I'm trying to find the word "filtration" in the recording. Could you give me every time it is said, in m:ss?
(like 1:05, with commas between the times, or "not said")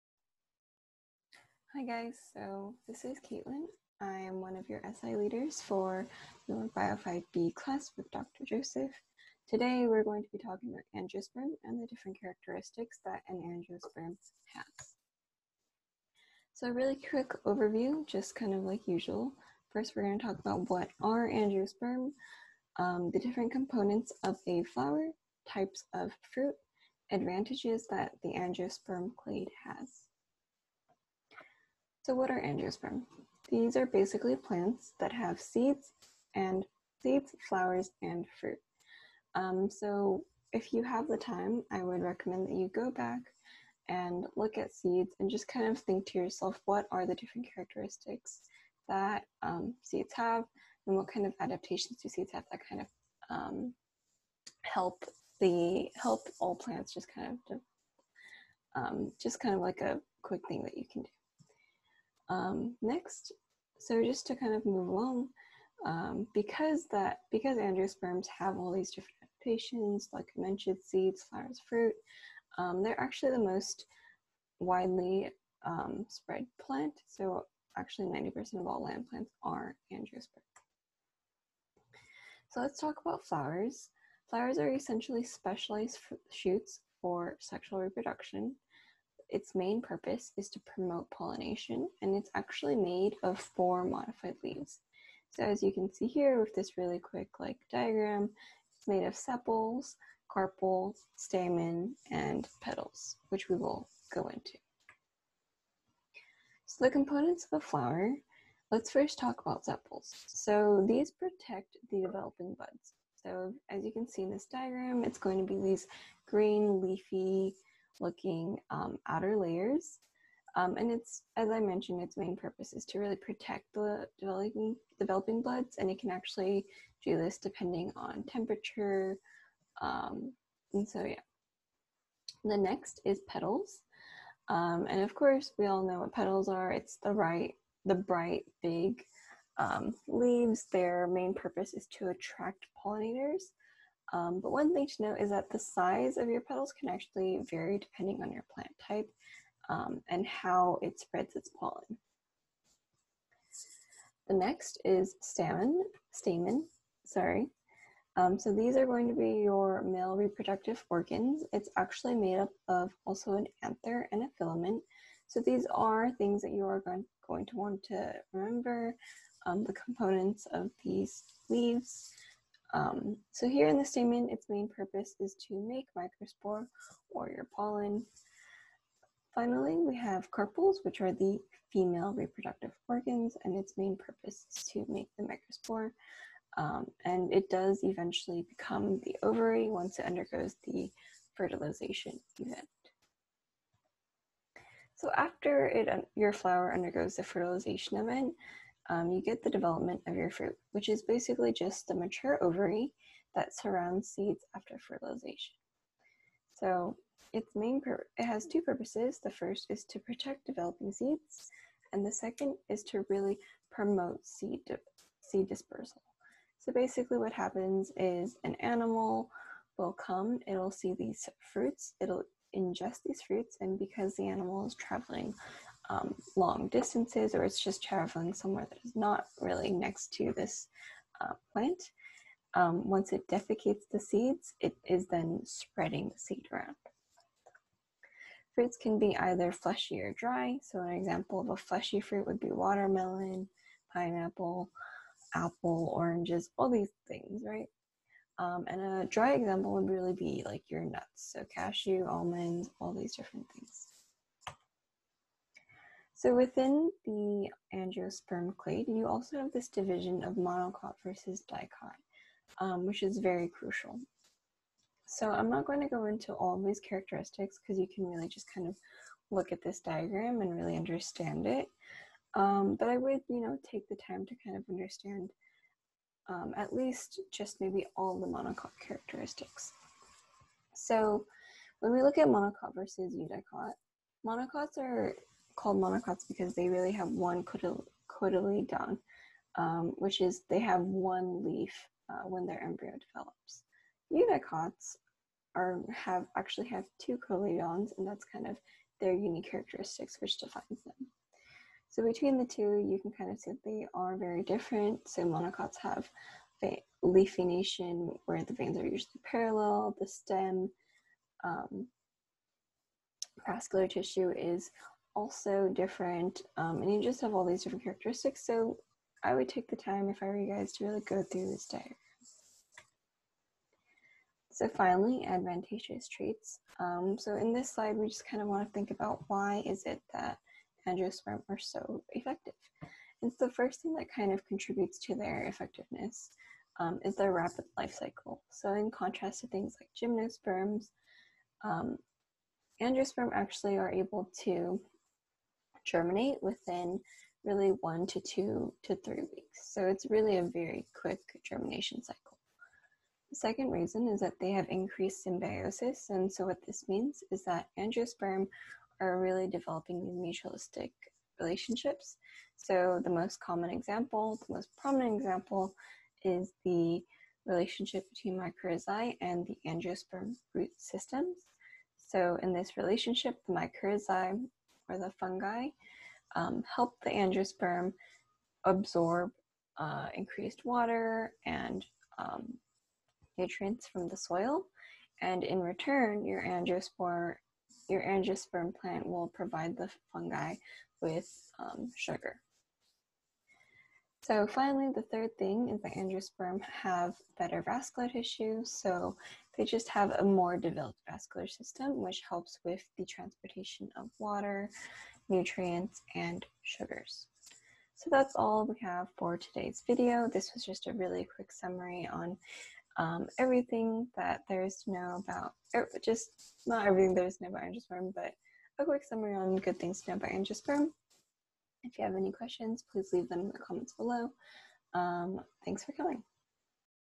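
not said.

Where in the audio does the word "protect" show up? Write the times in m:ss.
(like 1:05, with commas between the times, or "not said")
1:51, 2:03, 3:29.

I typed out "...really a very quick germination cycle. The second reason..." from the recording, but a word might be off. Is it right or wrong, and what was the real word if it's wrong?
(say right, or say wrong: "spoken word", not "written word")
right.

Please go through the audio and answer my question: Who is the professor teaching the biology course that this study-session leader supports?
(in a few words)
Dr. Joseph.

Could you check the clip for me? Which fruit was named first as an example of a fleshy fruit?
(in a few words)
watermelon.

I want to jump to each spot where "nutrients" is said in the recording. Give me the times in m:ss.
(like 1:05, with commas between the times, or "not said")
6:23, 6:45.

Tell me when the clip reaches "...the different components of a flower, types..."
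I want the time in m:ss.
0:23.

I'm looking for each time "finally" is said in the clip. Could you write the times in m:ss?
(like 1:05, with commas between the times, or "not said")
2:59, 5:24, 6:34.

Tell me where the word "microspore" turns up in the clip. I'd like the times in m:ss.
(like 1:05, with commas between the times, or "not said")
2:55, 3:05.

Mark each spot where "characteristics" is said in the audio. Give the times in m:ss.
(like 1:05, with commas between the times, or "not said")
0:12, 0:47, 4:26, 4:38, 4:59, 5:17.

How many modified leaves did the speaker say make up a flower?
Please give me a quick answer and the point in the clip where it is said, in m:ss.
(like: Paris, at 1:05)
4, at 1:33.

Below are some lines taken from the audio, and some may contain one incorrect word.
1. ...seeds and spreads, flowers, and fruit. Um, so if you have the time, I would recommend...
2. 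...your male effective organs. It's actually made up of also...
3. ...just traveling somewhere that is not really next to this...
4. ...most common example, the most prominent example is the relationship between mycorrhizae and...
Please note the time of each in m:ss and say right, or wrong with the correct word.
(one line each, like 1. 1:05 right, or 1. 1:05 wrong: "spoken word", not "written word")
1. 0:35 wrong: "seeds", not "spreads"
2. 2:39 wrong: "reproductive", not "effective"
3. 3:47 right
4. 6:03 right.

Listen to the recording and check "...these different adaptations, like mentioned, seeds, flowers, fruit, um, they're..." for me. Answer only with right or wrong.
right.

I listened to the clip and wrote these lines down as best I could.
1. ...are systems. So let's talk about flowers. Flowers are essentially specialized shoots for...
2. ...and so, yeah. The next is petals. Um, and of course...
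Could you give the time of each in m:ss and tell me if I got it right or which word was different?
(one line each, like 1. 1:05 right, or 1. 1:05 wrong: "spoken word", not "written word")
1. 1:19 wrong: "angiosperms", not "systems"
2. 2:10 right.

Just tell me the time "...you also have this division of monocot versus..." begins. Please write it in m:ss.
4:18.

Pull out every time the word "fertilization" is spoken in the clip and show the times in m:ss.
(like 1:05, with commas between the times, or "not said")
3:11, 3:17, 3:24.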